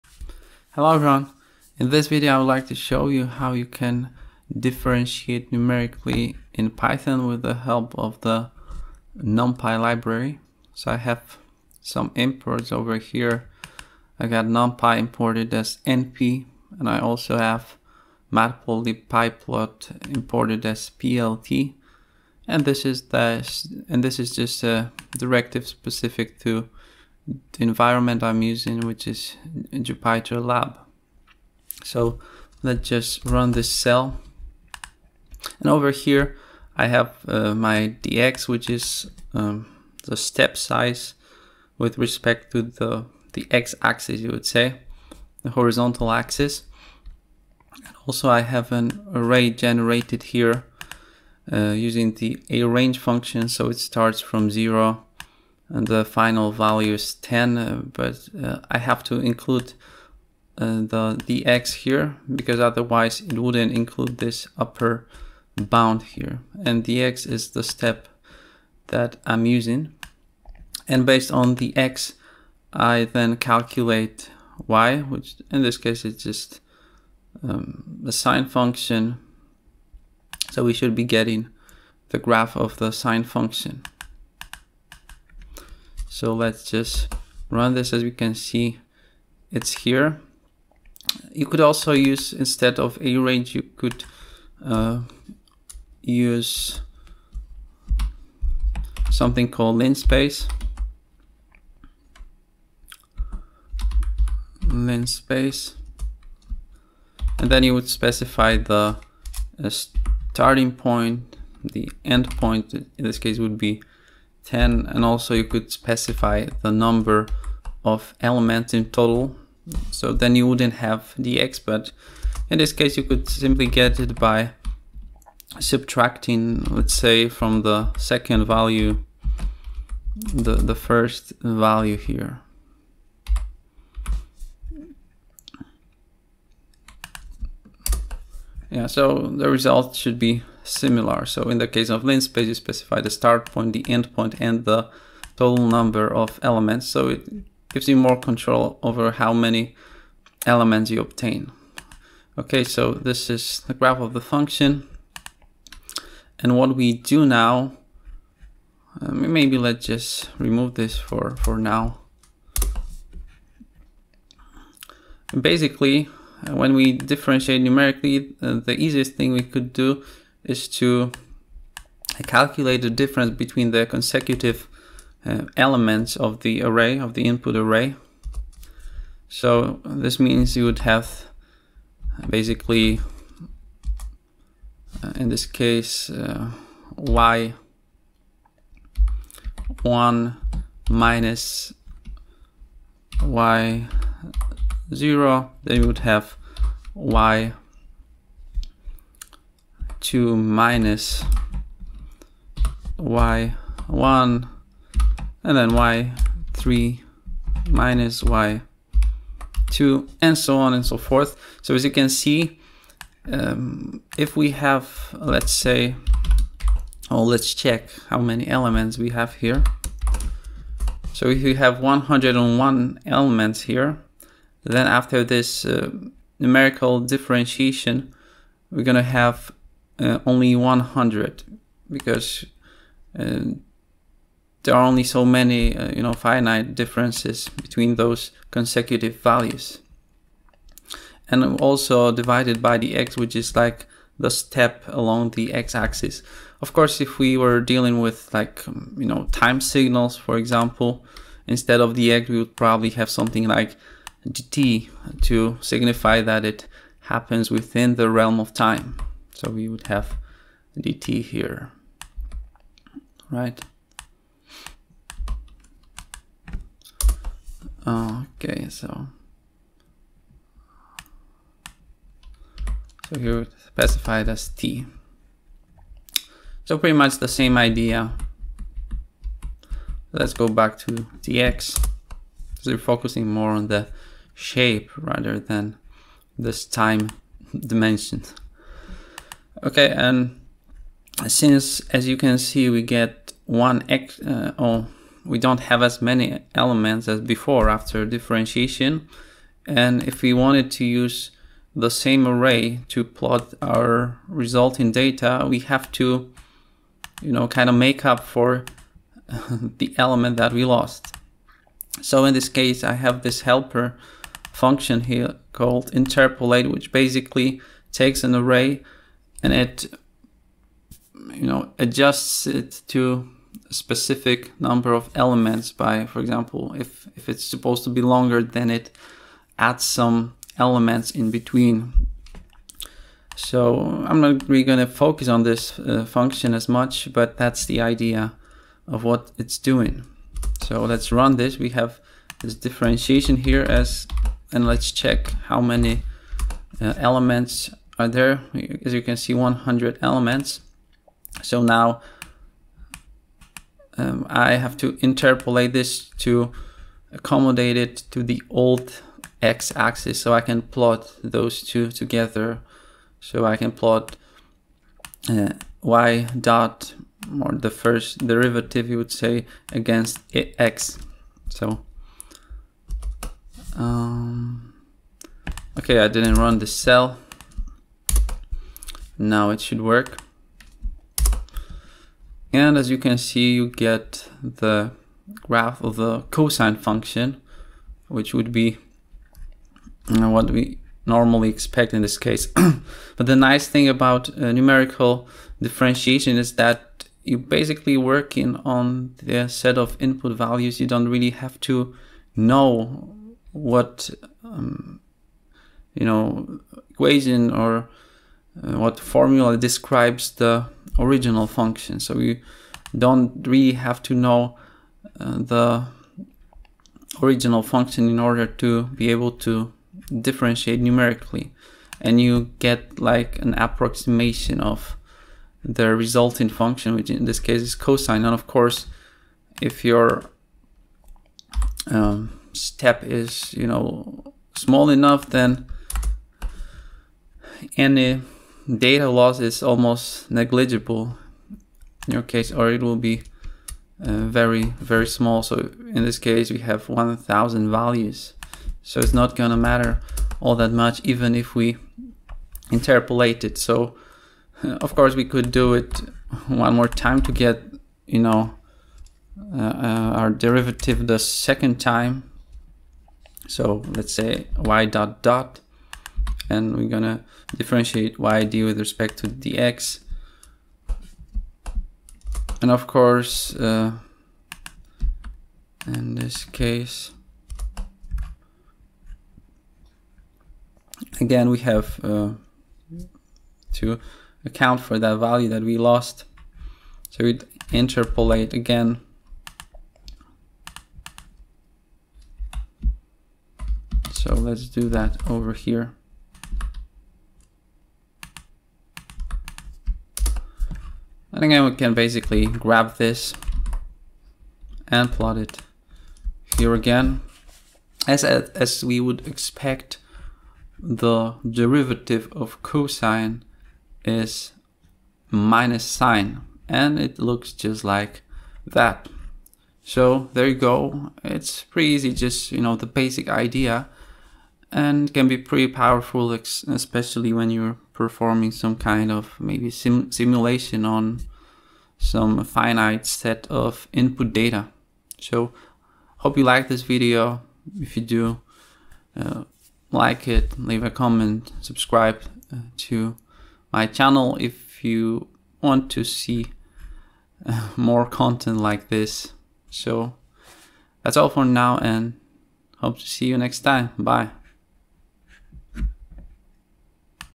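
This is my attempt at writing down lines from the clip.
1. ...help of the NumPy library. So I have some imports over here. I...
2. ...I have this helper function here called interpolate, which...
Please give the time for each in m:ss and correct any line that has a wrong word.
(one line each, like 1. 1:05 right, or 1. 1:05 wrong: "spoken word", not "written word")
1. 0:07 right
2. 5:12 right.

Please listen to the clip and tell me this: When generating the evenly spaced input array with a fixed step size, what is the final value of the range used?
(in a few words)
10.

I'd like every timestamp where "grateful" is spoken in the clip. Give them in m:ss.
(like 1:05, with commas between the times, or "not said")
not said.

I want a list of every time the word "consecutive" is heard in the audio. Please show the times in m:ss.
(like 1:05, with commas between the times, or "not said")
2:53, 3:58.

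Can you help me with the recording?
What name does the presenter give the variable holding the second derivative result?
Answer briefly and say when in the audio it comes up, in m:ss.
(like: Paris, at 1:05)
y dot dot, at 7:44.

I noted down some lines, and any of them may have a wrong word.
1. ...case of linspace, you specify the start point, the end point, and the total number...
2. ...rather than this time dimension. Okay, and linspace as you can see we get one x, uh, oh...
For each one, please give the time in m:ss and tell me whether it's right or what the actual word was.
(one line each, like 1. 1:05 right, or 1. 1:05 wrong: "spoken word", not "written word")
1. 2:21 right
2. 4:44 wrong: "since", not "linspace".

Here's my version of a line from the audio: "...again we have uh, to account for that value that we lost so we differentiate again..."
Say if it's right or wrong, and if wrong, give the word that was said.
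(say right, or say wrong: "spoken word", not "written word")
wrong: "interpolate", not "differentiate".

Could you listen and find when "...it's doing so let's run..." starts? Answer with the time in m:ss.
5:39.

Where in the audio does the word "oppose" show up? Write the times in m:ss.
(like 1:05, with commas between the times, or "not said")
not said.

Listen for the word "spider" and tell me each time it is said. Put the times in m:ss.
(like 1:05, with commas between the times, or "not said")
not said.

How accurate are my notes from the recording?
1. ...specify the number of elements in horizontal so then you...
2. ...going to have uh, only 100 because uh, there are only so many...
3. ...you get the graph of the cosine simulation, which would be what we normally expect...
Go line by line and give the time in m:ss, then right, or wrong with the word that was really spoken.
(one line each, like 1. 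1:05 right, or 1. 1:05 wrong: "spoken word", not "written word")
1. 1:55 wrong: "total", not "horizontal"
2. 3:48 right
3. 6:23 wrong: "function", not "simulation".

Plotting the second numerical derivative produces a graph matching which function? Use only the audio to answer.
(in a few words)
minus sine.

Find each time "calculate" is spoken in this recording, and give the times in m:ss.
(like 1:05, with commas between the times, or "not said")
1:13, 2:52.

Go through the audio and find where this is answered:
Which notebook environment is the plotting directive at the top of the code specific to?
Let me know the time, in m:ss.
0:29.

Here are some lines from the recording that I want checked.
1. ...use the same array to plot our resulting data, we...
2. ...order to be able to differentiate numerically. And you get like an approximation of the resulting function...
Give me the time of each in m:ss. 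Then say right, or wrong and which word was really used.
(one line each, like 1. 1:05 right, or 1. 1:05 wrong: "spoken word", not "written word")
1. 5:00 right
2. 6:58 right.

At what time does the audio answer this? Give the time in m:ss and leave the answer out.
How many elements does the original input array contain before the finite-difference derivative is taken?
3:41.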